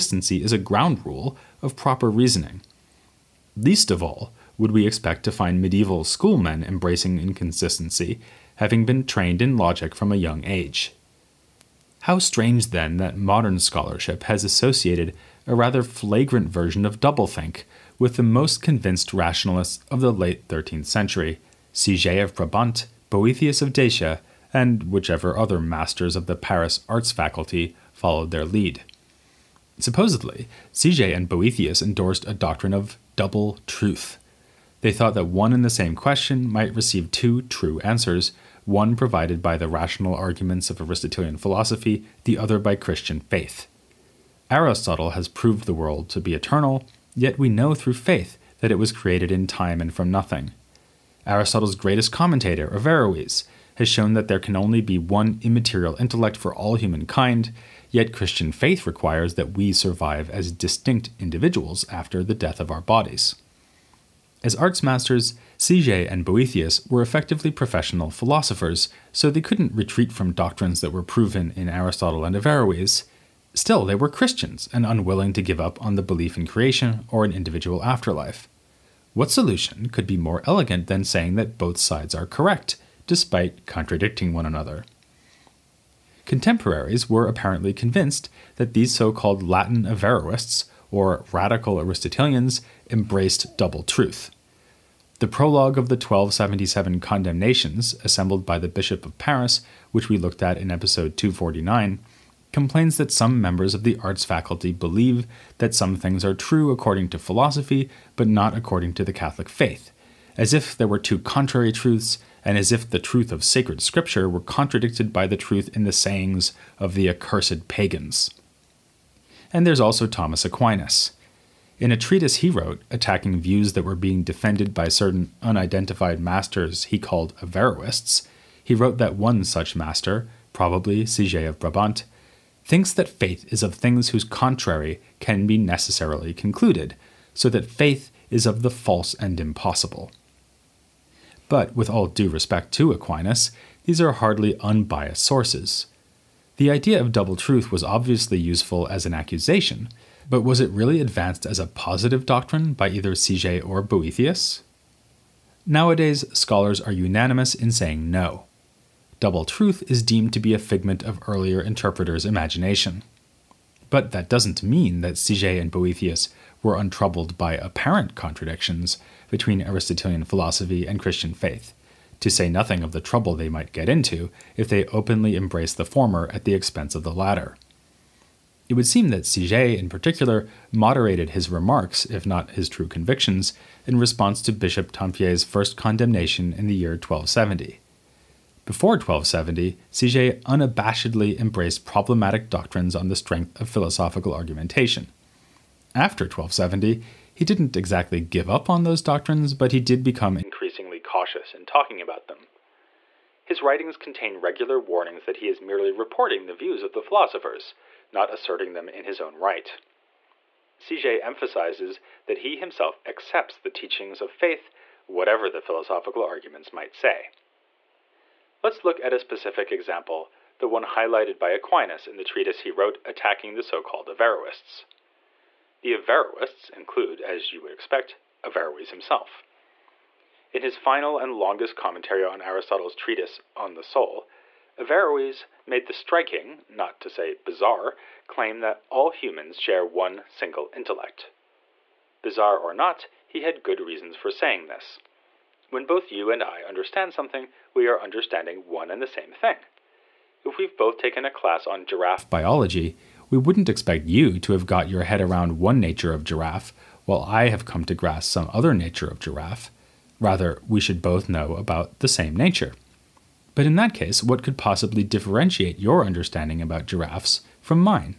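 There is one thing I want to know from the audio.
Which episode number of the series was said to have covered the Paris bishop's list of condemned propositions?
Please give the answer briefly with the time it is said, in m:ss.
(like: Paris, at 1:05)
249, at 1:40.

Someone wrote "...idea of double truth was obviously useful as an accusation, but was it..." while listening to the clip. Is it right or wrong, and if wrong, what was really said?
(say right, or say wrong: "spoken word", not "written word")
right.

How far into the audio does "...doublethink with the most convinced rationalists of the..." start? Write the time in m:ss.
0:16.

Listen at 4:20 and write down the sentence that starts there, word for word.
Rather, we should both know about the same nature.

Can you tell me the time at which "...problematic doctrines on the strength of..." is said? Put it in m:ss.
3:11.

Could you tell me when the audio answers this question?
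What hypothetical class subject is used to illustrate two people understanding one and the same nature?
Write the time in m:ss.
4:11.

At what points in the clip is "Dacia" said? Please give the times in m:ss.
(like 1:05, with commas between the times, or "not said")
0:23.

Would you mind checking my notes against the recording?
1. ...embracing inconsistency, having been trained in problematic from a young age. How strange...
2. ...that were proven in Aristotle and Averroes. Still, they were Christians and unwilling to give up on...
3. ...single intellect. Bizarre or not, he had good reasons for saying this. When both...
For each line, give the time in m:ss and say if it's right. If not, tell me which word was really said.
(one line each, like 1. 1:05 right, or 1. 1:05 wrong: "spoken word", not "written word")
1. 0:06 wrong: "logic", not "problematic"
2. 1:10 right
3. 4:00 right.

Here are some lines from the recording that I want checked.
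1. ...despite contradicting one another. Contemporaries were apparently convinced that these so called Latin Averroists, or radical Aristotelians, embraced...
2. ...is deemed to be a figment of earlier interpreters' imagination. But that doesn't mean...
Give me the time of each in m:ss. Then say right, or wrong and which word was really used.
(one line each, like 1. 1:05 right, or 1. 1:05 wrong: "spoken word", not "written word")
1. 1:23 right
2. 2:39 right.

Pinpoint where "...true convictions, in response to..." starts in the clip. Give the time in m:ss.
3:02.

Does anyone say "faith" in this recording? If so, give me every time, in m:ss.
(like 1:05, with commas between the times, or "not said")
0:43, 0:47, 0:58, 1:49, 2:13, 2:17, 2:51, 3:34.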